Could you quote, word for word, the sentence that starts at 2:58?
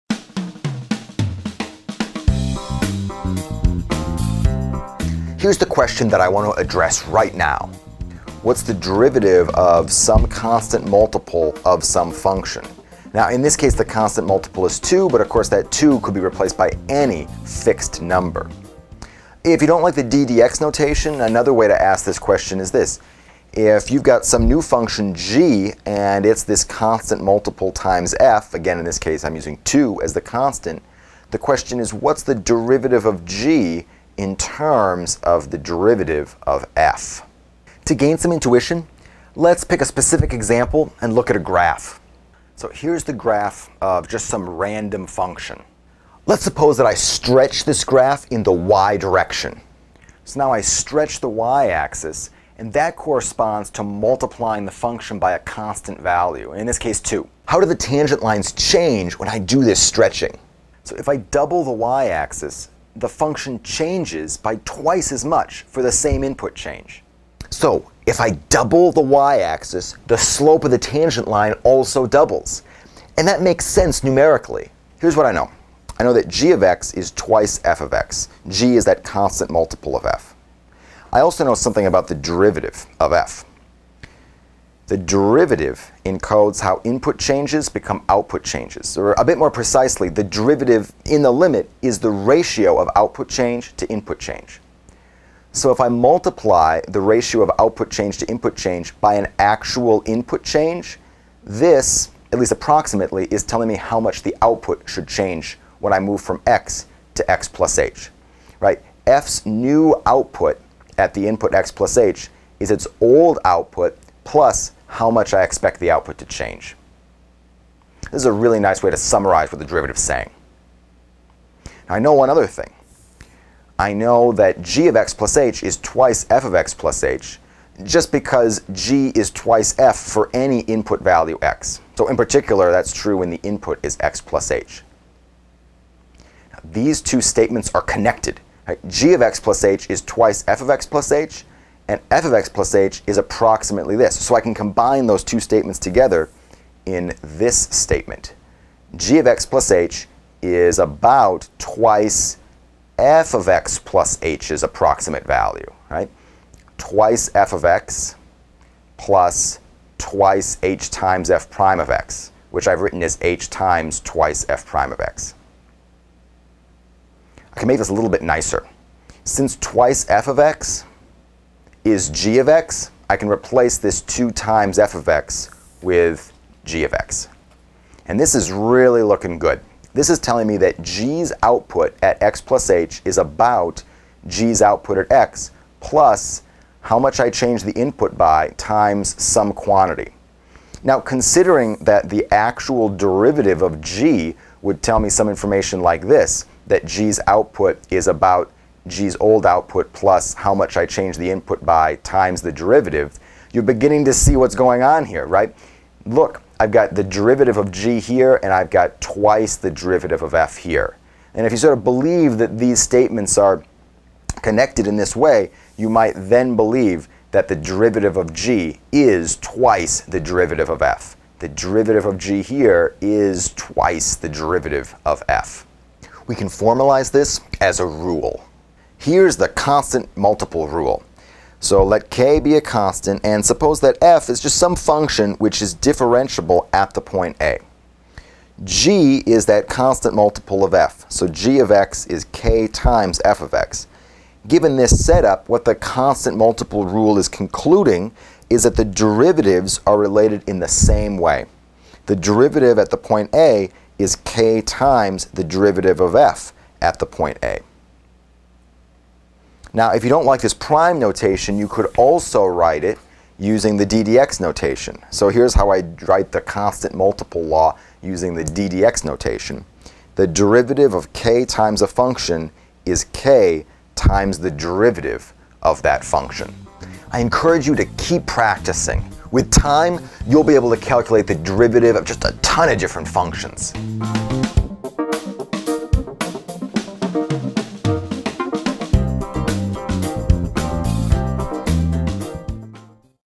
And this is really looking good.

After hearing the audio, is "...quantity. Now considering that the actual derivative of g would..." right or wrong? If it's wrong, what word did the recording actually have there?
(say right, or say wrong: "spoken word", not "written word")
right.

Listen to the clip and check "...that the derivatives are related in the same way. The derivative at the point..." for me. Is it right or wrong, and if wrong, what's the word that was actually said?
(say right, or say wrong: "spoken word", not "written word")
right.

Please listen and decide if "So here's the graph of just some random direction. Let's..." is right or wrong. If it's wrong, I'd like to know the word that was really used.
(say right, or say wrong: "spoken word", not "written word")
wrong: "function", not "direction".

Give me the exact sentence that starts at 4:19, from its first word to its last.
Now, if you don't like this prime notation, you could also write it using the ddx notation.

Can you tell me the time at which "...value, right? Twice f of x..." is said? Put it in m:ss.
2:35.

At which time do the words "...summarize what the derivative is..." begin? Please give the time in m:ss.
1:58.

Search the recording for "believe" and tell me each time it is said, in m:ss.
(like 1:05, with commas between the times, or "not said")
3:31, 3:36.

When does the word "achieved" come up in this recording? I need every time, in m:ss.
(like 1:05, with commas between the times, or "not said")
not said.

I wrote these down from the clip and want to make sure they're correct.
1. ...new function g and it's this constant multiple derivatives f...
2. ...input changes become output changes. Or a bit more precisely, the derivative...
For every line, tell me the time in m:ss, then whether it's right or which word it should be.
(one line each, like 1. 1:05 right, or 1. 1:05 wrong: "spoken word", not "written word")
1. 0:24 wrong: "times", not "derivatives"
2. 1:26 right.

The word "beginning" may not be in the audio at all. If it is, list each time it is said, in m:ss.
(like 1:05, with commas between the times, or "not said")
3:23.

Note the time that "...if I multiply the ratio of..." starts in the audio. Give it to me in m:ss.
1:35.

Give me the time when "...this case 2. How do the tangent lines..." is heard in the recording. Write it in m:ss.
0:56.